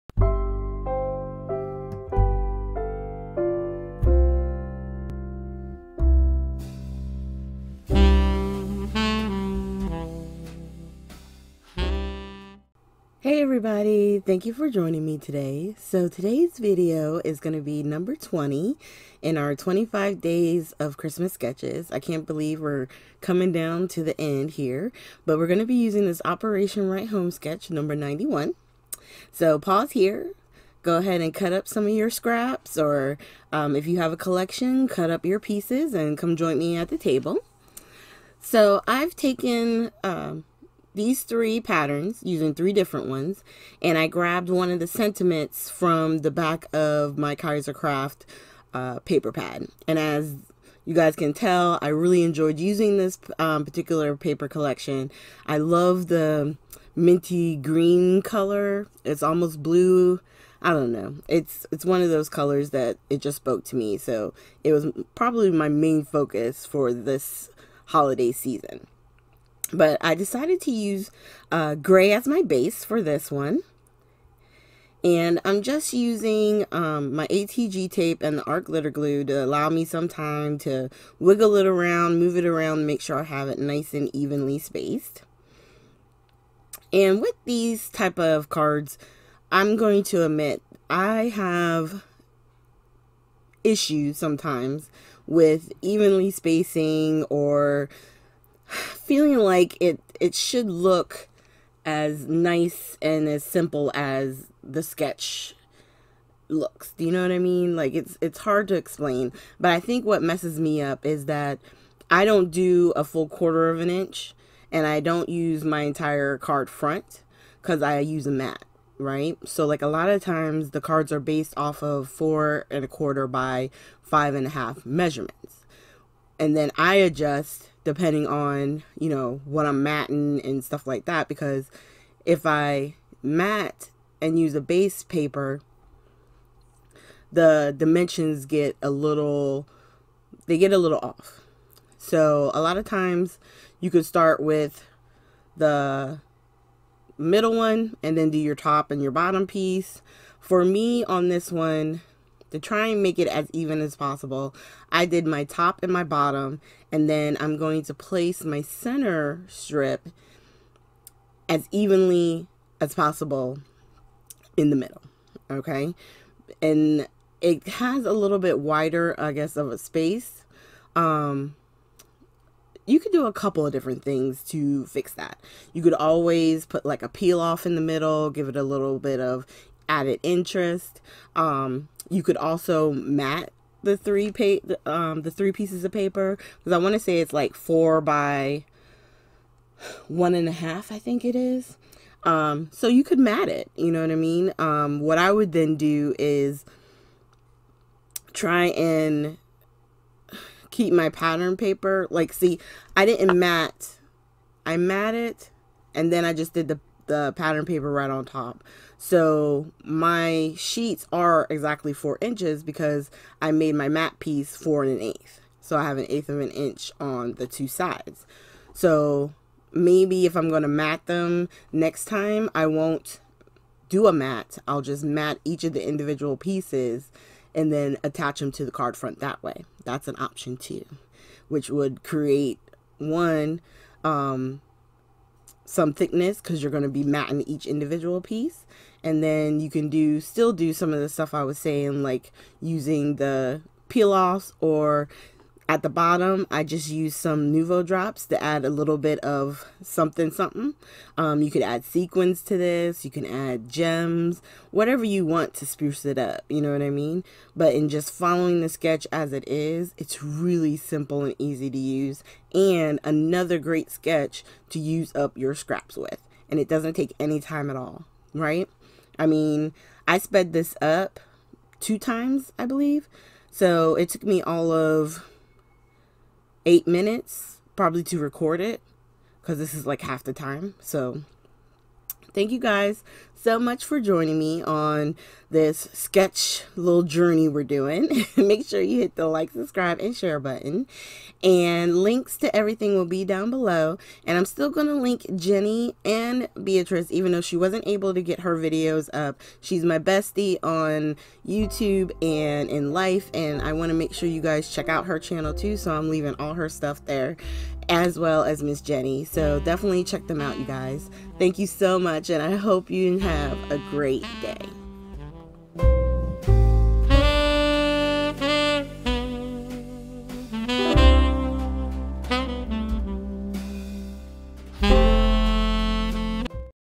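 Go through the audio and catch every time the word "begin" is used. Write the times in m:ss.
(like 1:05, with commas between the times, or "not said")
not said.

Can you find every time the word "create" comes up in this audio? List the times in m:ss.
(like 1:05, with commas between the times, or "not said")
3:52.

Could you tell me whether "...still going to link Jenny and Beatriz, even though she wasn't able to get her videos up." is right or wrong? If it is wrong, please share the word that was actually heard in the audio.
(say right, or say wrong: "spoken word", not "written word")
right.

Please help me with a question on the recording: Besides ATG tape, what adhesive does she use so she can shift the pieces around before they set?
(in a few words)
Art glitter glue.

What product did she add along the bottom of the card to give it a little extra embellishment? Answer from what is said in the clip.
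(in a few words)
Nuvo drops.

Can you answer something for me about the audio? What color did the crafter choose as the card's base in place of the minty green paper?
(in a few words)
Gray.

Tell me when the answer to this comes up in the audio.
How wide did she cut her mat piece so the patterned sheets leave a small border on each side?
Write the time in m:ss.
3:34.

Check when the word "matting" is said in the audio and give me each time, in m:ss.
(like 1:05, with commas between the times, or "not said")
2:09, 3:57.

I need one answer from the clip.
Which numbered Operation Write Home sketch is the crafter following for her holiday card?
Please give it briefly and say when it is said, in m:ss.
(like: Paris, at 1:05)
91, at 0:27.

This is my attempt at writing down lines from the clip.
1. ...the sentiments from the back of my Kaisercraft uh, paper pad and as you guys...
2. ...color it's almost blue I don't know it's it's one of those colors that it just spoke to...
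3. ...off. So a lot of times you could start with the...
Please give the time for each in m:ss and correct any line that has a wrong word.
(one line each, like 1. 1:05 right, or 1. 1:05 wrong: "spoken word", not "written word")
1. 0:44 right
2. 0:58 right
3. 2:20 right.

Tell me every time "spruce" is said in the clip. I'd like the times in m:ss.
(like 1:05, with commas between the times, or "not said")
4:15.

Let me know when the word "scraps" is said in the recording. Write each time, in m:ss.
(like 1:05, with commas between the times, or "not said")
0:32, 4:25.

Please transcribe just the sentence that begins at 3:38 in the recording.
So maybe if I'm going to mat them next time, I won't do a mat.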